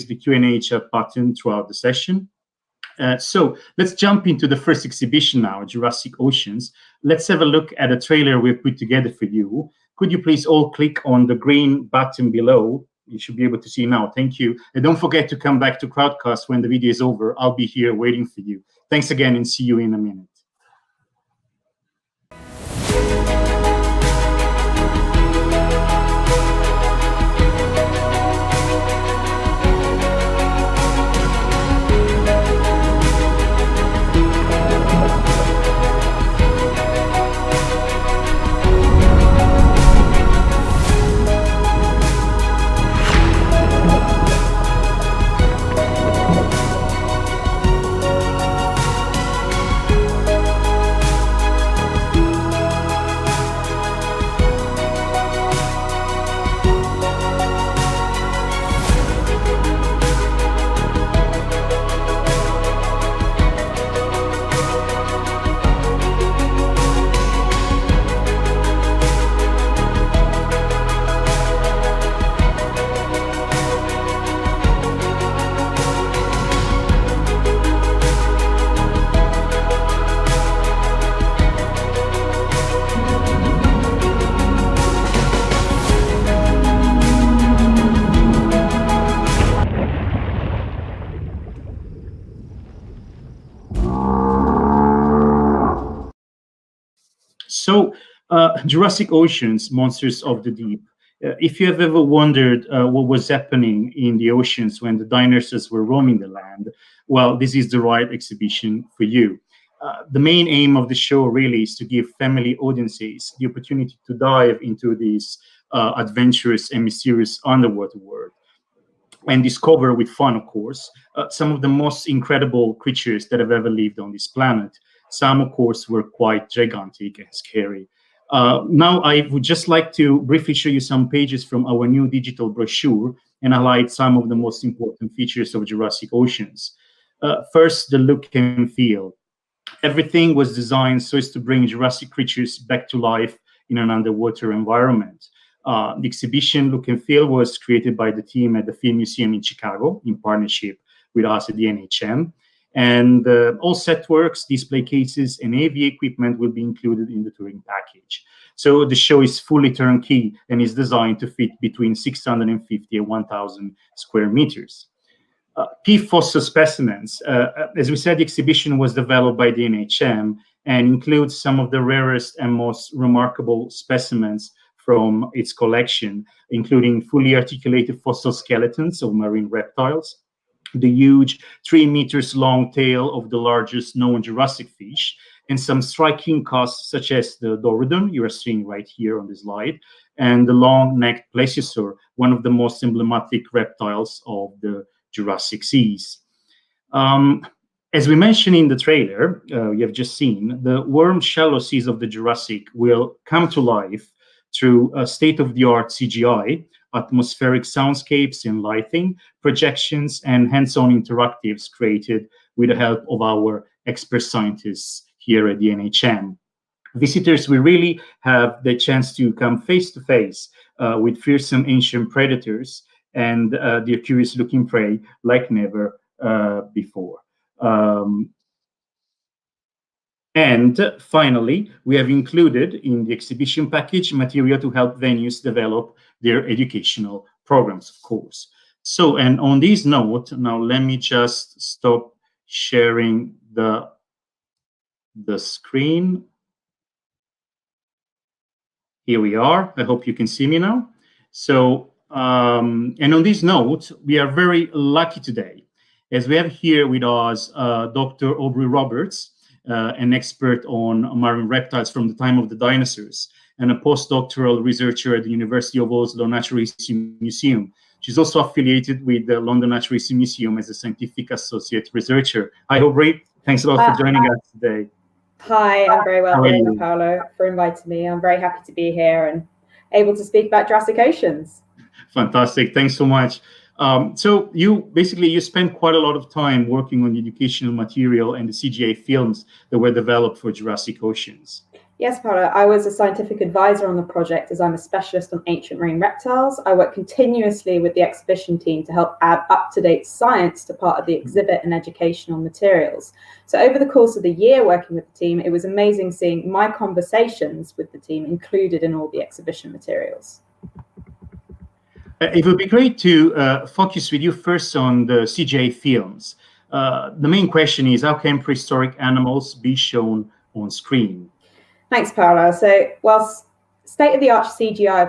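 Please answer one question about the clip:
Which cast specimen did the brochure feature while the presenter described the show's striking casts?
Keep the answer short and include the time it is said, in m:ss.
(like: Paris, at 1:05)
Dorodon, at 3:07.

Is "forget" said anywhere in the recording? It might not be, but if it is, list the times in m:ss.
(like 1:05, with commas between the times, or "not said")
0:14.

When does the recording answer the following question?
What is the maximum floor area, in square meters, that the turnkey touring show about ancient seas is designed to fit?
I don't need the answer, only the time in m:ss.
2:43.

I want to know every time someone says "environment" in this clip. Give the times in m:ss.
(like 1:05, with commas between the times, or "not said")
2:24.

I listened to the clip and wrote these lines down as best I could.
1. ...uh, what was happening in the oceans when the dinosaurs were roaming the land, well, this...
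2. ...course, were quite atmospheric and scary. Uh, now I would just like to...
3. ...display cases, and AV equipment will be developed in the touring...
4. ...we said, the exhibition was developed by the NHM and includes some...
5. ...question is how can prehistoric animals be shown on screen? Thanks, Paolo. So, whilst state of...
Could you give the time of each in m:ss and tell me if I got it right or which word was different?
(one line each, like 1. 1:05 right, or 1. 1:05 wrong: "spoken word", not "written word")
1. 1:42 right
2. 2:05 wrong: "gigantic", not "atmospheric"
3. 2:34 wrong: "included", not "developed"
4. 2:47 right
5. 5:17 right.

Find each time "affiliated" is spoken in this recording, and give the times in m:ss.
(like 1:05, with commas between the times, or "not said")
4:28.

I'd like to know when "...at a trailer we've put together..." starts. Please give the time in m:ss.
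0:07.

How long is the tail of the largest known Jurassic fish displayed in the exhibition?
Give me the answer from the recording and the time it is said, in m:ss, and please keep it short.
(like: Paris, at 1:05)
3 meters, at 3:01.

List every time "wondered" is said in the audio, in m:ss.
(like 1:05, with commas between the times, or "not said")
1:42.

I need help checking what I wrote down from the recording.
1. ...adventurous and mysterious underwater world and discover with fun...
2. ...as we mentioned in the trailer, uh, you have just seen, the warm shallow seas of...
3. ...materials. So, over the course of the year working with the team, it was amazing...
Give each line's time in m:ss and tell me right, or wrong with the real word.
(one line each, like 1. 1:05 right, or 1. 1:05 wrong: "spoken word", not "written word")
1. 1:55 right
2. 3:17 right
3. 5:02 right.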